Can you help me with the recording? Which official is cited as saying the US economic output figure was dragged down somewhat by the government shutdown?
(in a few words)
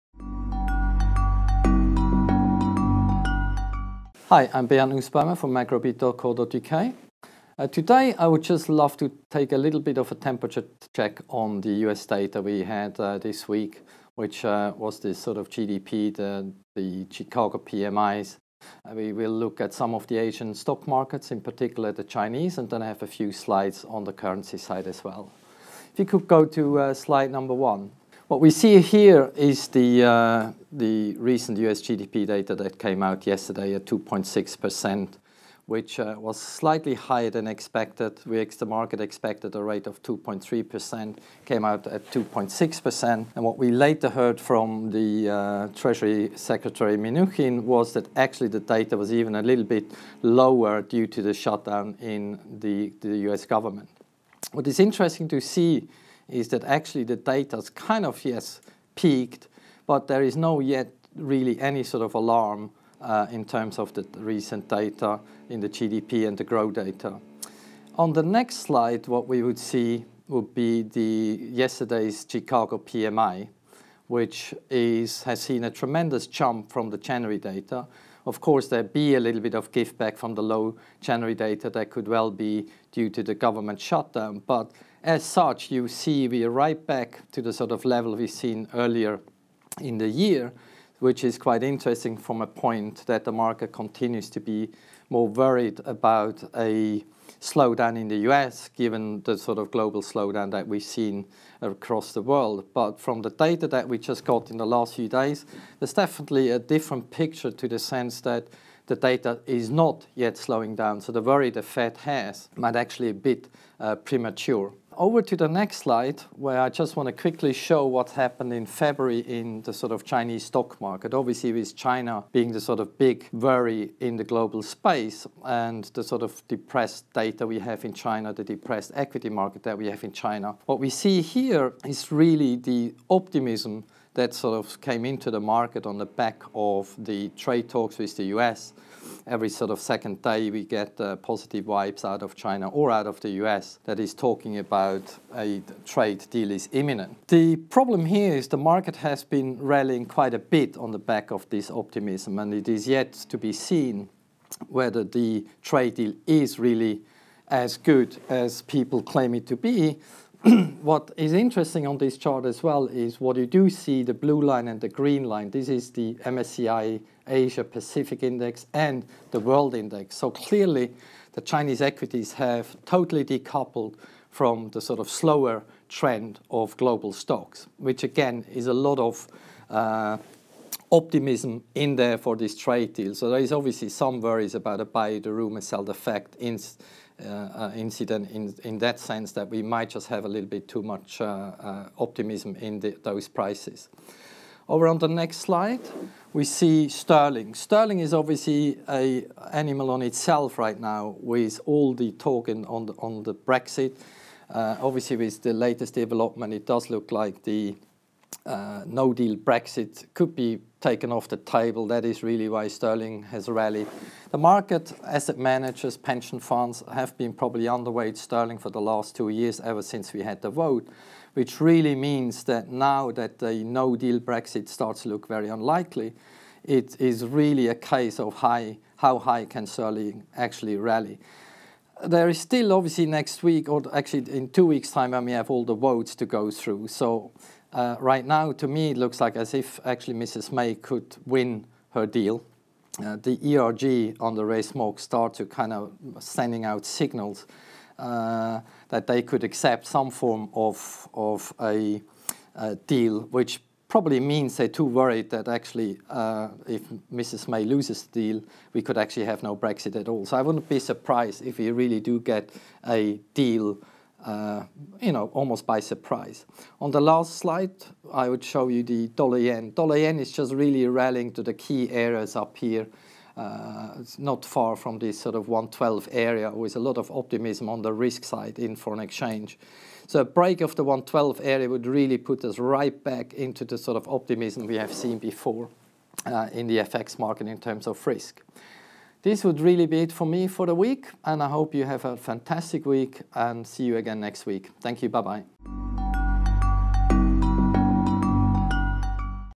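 Mnuchin.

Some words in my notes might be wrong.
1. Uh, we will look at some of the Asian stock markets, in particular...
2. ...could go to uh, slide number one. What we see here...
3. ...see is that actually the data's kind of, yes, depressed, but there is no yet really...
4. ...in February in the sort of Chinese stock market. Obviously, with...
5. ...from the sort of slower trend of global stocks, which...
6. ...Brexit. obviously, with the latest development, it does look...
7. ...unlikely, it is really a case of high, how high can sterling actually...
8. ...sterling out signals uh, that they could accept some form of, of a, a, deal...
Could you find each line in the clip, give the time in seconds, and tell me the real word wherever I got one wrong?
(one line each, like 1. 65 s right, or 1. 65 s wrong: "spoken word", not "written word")
1. 18 s right
2. 26 s right
3. 55 s wrong: "peaked", not "depressed"
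4. 118 s right
5. 174 s right
6. 203 s right
7. 225 s right
8. 246 s wrong: "sending", not "sterling".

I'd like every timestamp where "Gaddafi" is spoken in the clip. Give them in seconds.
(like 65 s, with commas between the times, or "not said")
not said.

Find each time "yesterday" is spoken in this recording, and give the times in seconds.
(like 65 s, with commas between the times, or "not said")
33 s, 71 s.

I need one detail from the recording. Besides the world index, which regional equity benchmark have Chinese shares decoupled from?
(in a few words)
MSCI Asia Pacific Index.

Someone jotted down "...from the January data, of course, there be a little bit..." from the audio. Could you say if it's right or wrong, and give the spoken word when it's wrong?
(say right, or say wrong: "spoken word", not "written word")
right.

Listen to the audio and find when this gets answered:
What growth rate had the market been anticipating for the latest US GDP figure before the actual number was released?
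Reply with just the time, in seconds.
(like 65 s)
40 s.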